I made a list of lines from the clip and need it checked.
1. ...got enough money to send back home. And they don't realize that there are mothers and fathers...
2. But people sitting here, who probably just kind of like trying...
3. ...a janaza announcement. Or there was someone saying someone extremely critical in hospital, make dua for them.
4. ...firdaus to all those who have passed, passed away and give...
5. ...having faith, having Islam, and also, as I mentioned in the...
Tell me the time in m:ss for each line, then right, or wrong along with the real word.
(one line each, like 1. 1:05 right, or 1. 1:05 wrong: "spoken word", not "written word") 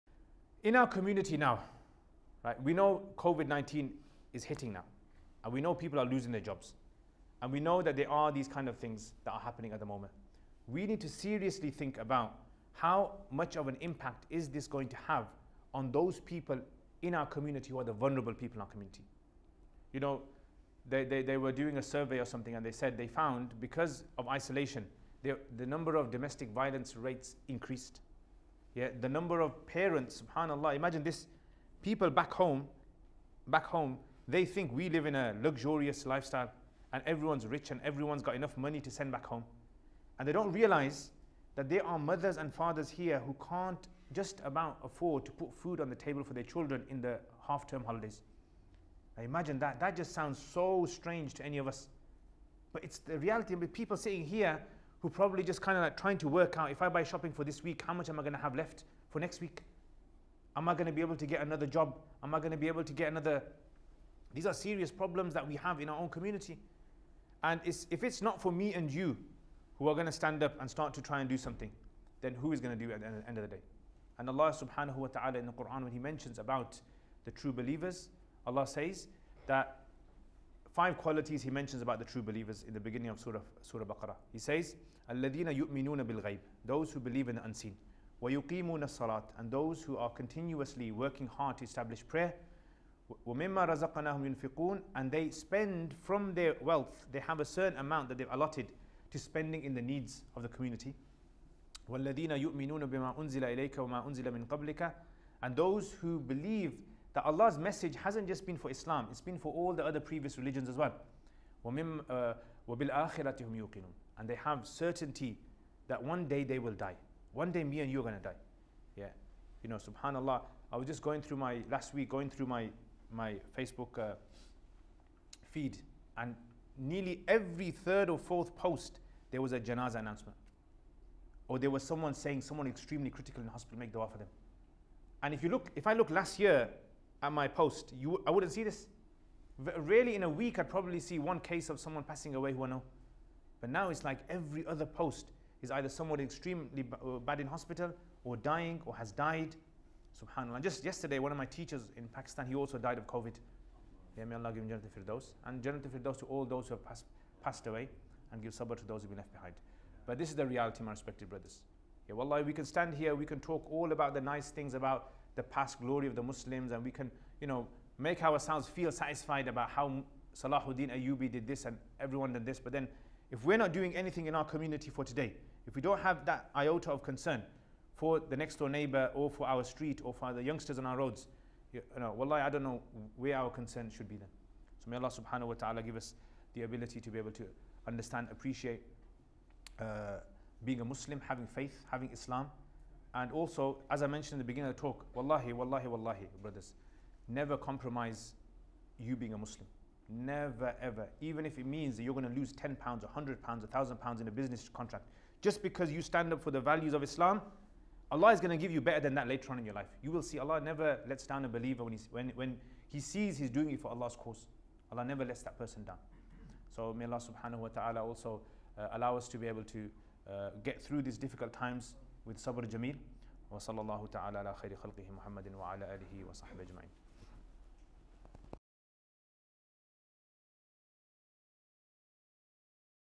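1. 0:38 right
2. 0:53 right
3. 2:09 right
4. 2:35 right
5. 3:11 right.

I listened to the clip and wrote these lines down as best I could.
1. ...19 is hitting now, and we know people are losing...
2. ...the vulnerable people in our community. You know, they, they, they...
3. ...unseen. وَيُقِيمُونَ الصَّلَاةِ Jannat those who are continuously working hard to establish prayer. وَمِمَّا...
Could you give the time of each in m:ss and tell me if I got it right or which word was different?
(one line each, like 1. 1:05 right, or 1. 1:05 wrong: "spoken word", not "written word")
1. 0:03 right
2. 0:17 right
3. 1:27 wrong: "And", not "Jannat".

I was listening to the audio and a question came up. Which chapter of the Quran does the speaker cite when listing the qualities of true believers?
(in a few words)
Surah Baqarah.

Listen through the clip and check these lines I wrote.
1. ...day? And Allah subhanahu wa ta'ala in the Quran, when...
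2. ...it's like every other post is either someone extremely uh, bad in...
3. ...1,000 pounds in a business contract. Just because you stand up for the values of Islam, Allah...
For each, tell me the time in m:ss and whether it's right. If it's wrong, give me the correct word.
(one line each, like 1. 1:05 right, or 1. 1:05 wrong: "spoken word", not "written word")
1. 1:13 right
2. 2:23 right
3. 3:23 right.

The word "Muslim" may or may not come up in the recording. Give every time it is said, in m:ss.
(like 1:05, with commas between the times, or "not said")
2:46, 3:10, 3:19.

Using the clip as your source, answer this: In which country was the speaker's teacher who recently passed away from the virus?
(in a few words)
Pakistan.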